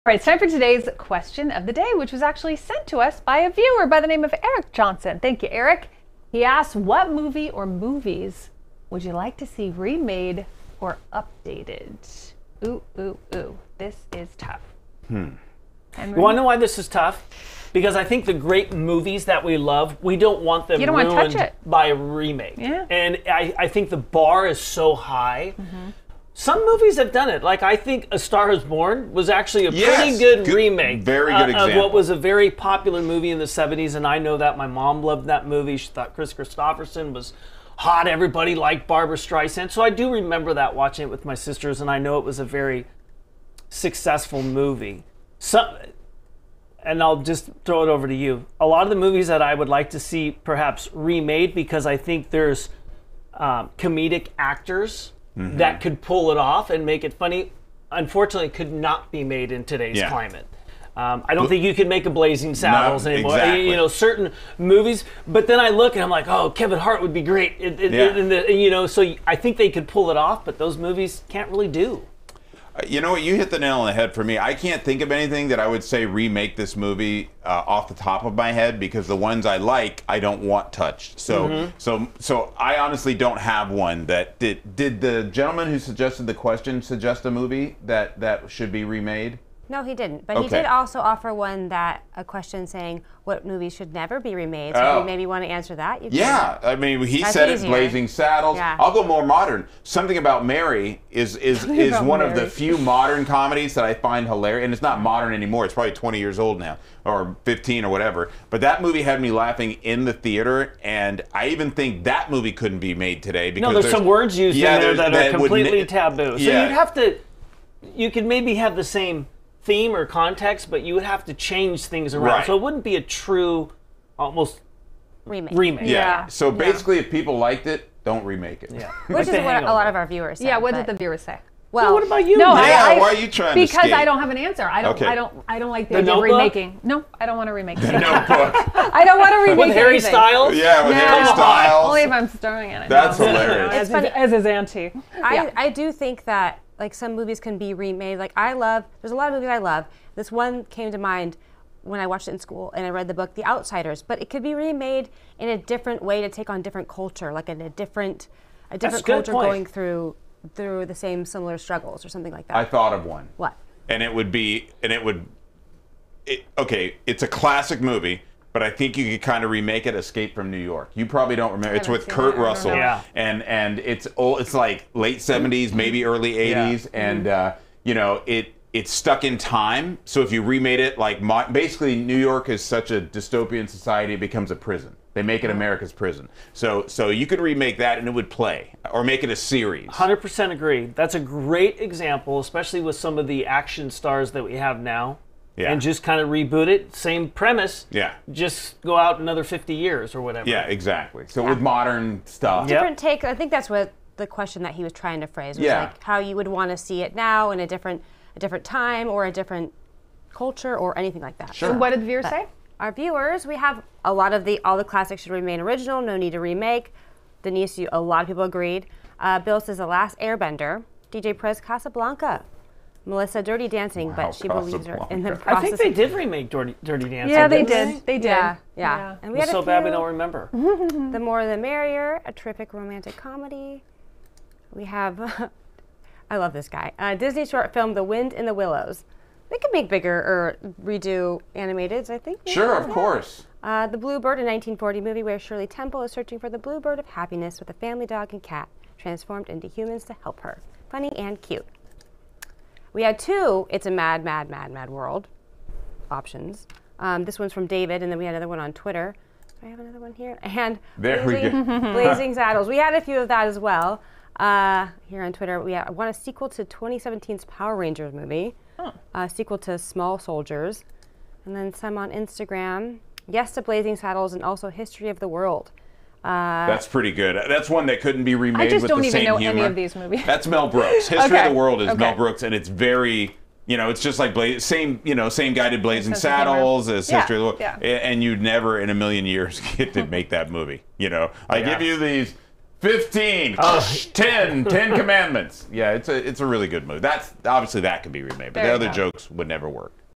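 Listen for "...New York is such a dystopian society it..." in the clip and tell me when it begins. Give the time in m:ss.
3:01.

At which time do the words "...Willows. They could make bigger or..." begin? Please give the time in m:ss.
3:58.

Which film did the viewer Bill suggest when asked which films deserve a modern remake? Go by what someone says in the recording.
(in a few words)
The Last Airbender.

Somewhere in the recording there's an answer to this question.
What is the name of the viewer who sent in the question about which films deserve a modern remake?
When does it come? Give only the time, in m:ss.
0:04.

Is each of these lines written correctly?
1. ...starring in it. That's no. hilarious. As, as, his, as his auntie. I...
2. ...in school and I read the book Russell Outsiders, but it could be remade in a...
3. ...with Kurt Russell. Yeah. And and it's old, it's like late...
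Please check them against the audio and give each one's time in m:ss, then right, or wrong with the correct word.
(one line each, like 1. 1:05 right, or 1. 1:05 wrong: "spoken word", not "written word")
1. 2:22 right
2. 2:32 wrong: "The", not "Russell"
3. 2:51 right.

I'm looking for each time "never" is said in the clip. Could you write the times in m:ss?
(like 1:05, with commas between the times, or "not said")
1:33, 4:48, 4:59.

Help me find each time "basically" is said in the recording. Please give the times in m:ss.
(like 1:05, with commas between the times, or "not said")
2:06, 3:01.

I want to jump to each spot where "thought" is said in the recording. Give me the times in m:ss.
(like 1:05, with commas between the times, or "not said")
0:35, 2:42.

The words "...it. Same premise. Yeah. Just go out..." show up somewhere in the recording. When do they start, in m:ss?
3:16.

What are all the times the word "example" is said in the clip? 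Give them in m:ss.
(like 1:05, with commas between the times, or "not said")
0:31, 3:11.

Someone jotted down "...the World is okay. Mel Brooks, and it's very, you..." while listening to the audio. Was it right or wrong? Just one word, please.
right.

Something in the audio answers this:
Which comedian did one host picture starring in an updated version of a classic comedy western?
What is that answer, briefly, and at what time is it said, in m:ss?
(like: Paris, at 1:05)
Kevin Hart, at 1:06.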